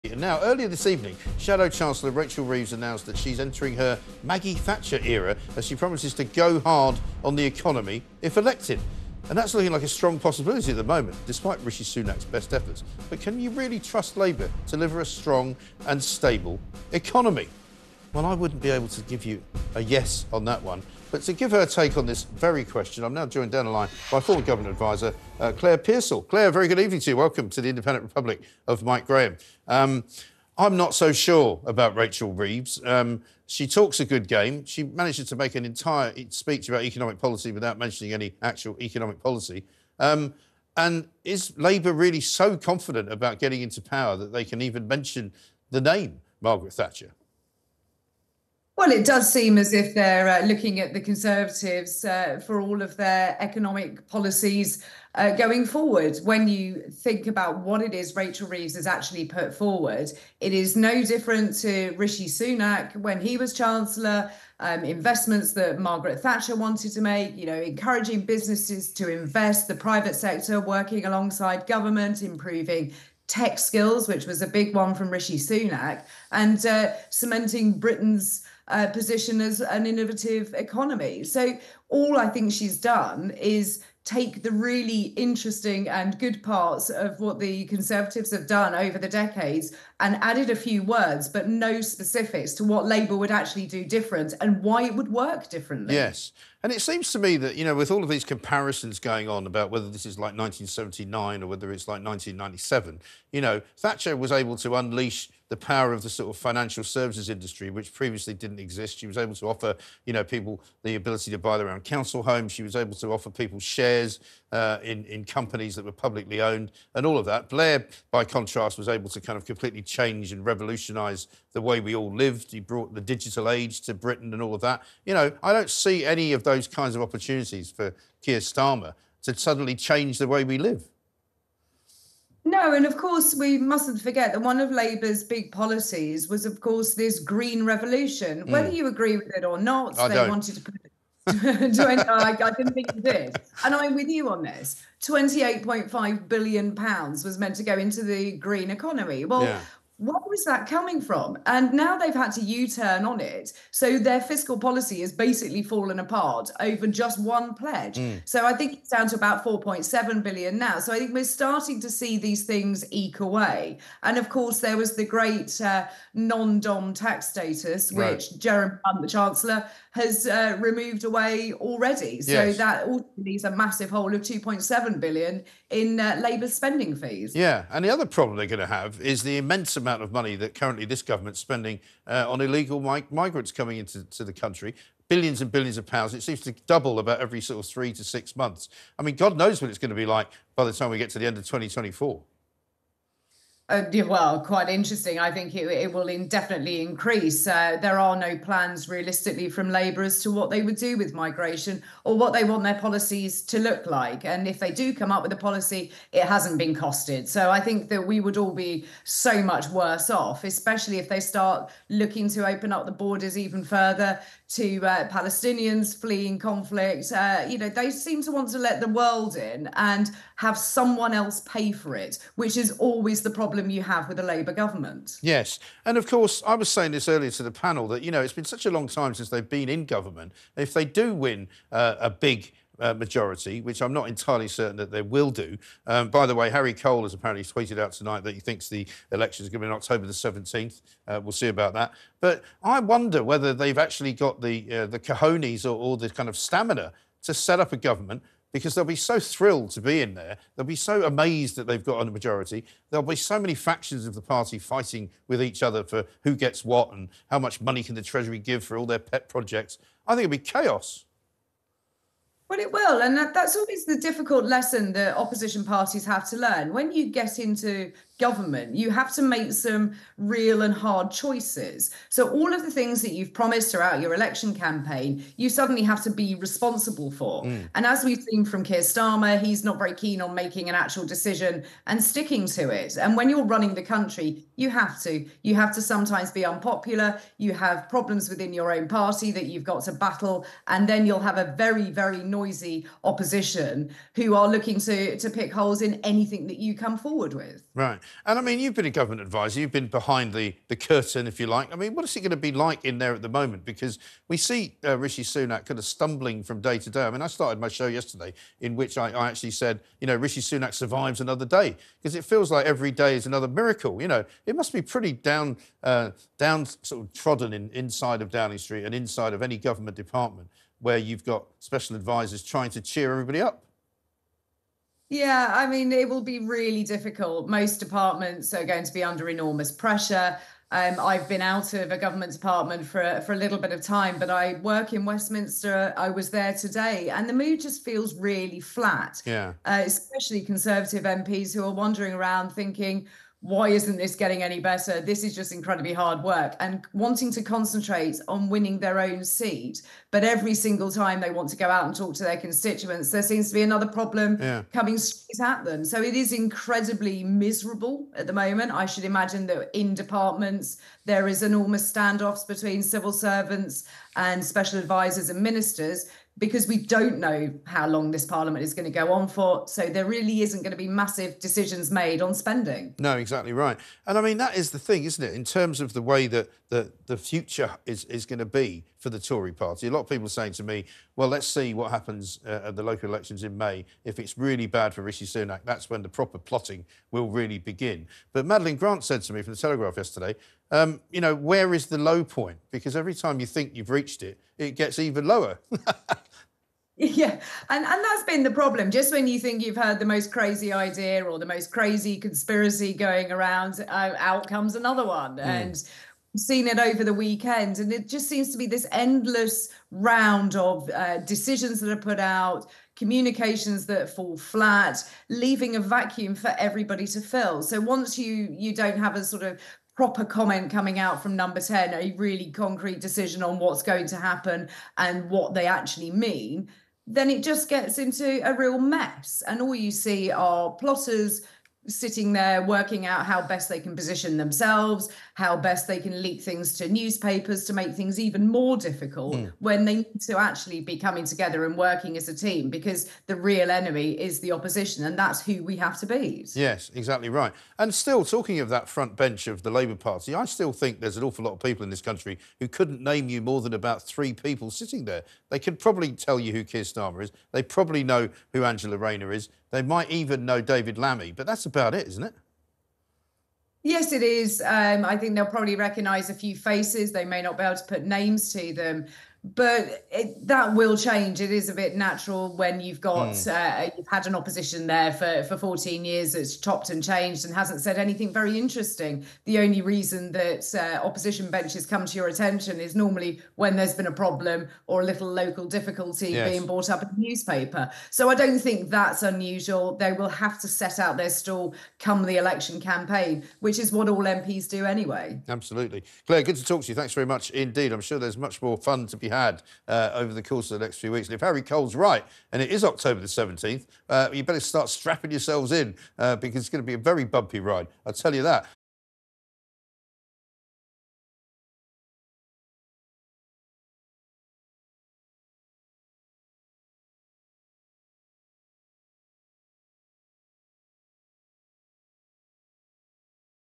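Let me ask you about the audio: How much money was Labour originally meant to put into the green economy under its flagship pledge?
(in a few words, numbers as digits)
28.5 billion pounds.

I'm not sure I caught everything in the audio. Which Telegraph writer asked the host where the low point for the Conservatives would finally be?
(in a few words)
Madeline Grant.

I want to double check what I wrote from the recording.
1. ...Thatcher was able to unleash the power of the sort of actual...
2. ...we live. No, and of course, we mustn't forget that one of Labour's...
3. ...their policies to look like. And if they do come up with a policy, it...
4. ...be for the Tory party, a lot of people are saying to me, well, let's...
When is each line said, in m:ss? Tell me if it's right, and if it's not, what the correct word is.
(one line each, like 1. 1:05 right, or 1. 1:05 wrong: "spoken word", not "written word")
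1. 1:43 wrong: "financial", not "actual"
2. 2:10 right
3. 3:22 right
4. 6:18 right.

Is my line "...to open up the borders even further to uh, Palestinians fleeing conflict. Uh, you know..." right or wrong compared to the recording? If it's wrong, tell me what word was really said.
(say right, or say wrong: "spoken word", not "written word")
right.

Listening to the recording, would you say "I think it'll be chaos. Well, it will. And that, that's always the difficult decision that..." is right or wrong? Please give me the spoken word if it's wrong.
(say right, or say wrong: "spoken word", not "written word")
wrong: "lesson", not "decision".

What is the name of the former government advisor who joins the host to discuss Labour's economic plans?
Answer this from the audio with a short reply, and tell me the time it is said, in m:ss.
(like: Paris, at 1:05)
Claire Pearsall, at 0:25.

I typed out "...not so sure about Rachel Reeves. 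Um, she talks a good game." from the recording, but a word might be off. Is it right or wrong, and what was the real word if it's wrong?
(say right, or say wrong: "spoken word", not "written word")
right.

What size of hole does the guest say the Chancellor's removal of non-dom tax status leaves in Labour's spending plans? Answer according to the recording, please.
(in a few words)
2.7 billion.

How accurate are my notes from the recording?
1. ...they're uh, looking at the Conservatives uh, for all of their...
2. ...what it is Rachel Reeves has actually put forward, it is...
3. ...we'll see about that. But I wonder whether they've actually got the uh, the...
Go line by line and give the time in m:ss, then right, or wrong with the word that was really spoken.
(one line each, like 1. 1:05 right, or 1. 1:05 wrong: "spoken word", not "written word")
1. 0:49 right
2. 0:57 right
3. 4:01 right.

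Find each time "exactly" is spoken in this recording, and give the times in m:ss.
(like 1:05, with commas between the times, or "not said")
6:13, 7:26.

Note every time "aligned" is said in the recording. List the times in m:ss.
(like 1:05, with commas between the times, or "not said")
not said.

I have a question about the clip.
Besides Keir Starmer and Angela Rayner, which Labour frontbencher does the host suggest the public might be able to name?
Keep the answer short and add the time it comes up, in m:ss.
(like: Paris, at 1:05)
David Lammy, at 7:40.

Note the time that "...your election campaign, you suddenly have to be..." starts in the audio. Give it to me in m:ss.
4:33.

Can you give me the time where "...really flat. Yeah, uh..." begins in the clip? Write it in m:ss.
5:38.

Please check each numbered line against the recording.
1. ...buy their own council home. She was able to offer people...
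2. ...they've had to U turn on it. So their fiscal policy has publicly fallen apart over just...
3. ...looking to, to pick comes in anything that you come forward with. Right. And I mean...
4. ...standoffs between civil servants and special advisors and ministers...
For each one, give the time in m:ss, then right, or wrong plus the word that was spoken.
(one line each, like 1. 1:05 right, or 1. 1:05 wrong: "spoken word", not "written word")
1. 1:51 right
2. 2:31 wrong: "basically", not "publicly"
3. 4:54 wrong: "holes", not "comes"
4. 6:01 right.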